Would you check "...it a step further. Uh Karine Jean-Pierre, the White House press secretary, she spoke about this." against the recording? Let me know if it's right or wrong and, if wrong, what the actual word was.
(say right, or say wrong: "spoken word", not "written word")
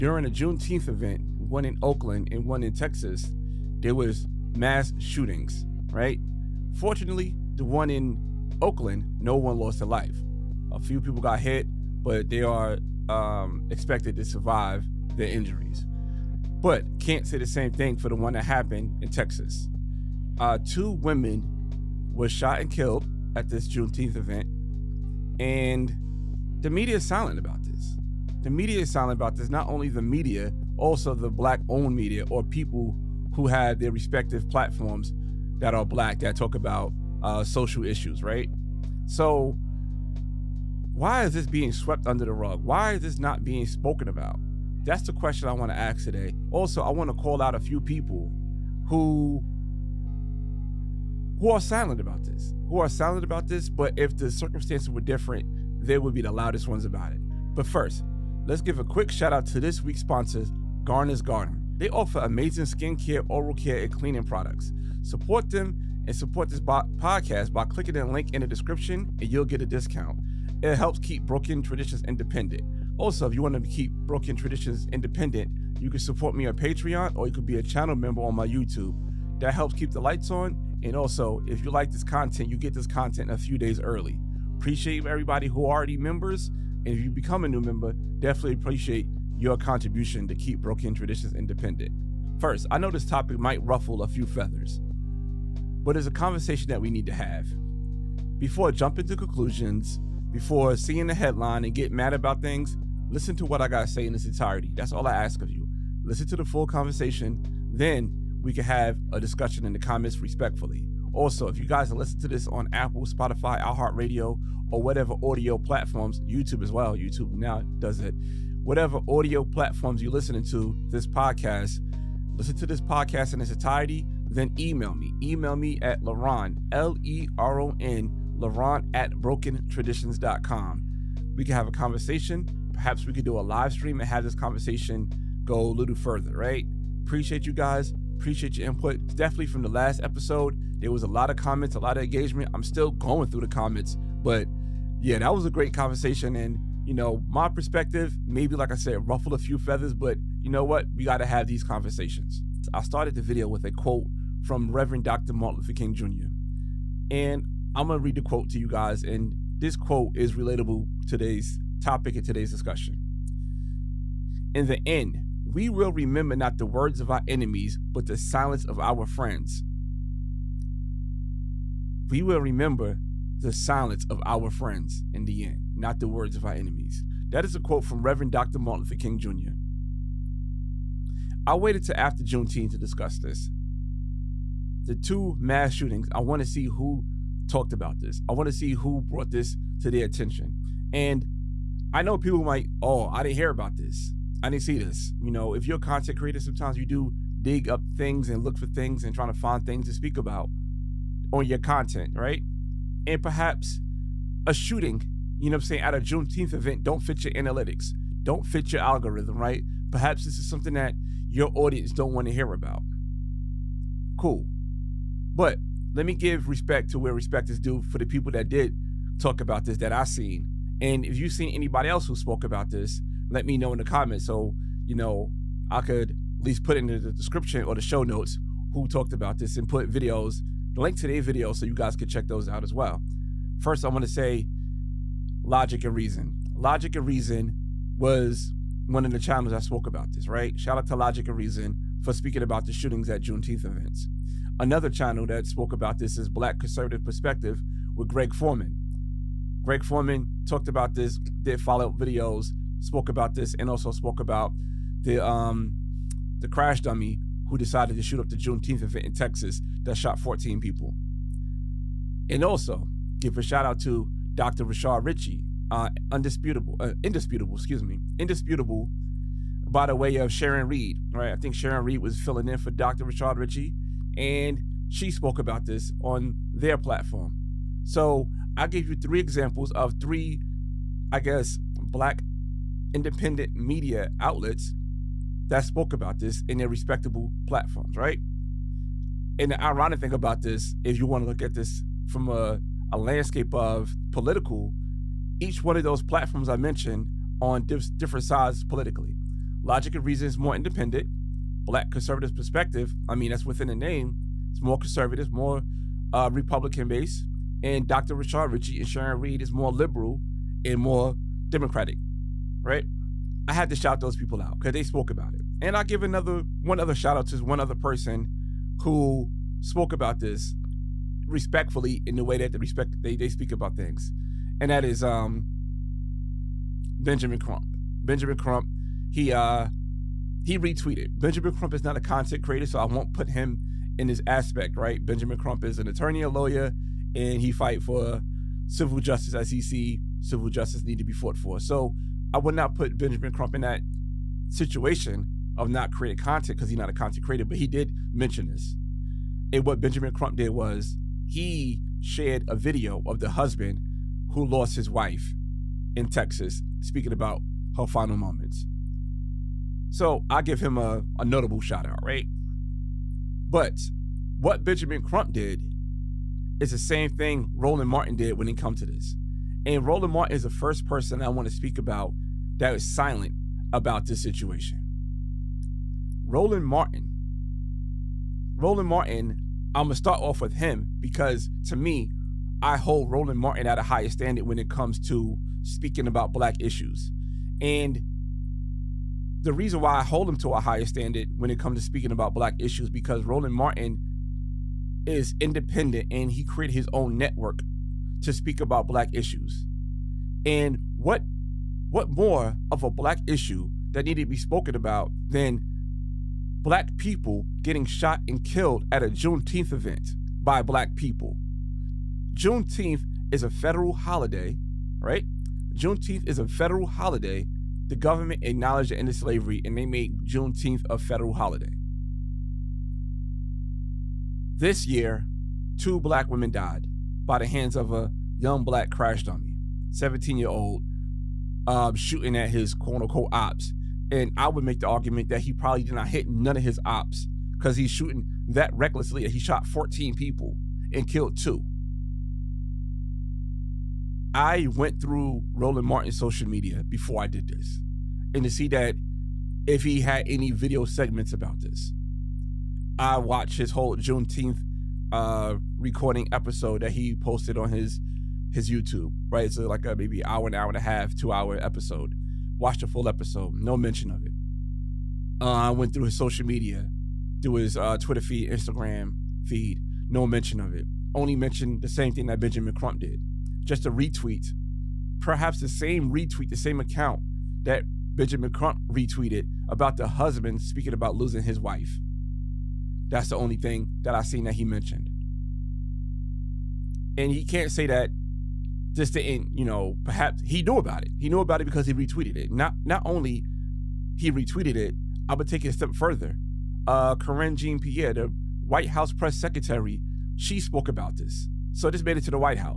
right.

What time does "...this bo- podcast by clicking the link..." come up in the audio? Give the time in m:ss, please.
1:06.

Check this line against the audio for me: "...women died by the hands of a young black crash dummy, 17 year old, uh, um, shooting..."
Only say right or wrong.
right.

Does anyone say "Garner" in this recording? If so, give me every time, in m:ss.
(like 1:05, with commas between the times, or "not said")
1:00.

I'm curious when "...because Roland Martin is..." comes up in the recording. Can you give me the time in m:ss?
6:32.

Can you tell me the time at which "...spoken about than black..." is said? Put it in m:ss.
6:44.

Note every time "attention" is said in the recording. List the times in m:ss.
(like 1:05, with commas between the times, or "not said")
3:10.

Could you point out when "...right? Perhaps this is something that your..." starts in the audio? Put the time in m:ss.
3:29.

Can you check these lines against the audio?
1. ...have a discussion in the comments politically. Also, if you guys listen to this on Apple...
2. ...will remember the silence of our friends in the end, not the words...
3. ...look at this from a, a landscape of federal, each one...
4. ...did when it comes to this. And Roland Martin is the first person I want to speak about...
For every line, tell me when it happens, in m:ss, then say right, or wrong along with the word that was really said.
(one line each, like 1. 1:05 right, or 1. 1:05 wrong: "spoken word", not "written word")
1. 1:48 wrong: "respectfully", not "politically"
2. 2:52 right
3. 4:51 wrong: "political", not "federal"
4. 6:08 right.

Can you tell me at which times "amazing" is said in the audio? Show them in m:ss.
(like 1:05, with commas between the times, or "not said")
1:02.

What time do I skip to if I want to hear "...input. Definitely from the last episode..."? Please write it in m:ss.
2:18.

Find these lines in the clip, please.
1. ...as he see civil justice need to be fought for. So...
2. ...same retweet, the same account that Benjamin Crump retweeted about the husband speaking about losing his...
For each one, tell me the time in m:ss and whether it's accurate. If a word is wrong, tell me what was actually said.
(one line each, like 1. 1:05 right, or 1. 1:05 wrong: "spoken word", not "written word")
1. 5:39 right
2. 7:55 right.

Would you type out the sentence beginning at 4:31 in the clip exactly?
I think Sharon Reed was filling in for Dr.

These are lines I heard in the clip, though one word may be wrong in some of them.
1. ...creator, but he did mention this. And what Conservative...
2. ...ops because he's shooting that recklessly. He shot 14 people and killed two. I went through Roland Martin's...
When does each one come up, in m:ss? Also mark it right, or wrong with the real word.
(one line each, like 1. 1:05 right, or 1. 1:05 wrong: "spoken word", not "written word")
1. 5:47 wrong: "Benjamin", not "Conservative"
2. 7:16 right.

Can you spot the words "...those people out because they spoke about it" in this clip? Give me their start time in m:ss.
5:14.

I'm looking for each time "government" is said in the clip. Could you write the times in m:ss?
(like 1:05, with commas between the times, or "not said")
6:57.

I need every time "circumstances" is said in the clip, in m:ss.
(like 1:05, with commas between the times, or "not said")
0:54.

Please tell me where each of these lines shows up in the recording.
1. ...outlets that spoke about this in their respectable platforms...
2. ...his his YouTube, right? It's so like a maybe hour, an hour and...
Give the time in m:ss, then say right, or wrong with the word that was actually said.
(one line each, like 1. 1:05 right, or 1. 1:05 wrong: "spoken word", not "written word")
1. 4:44 right
2. 7:37 right.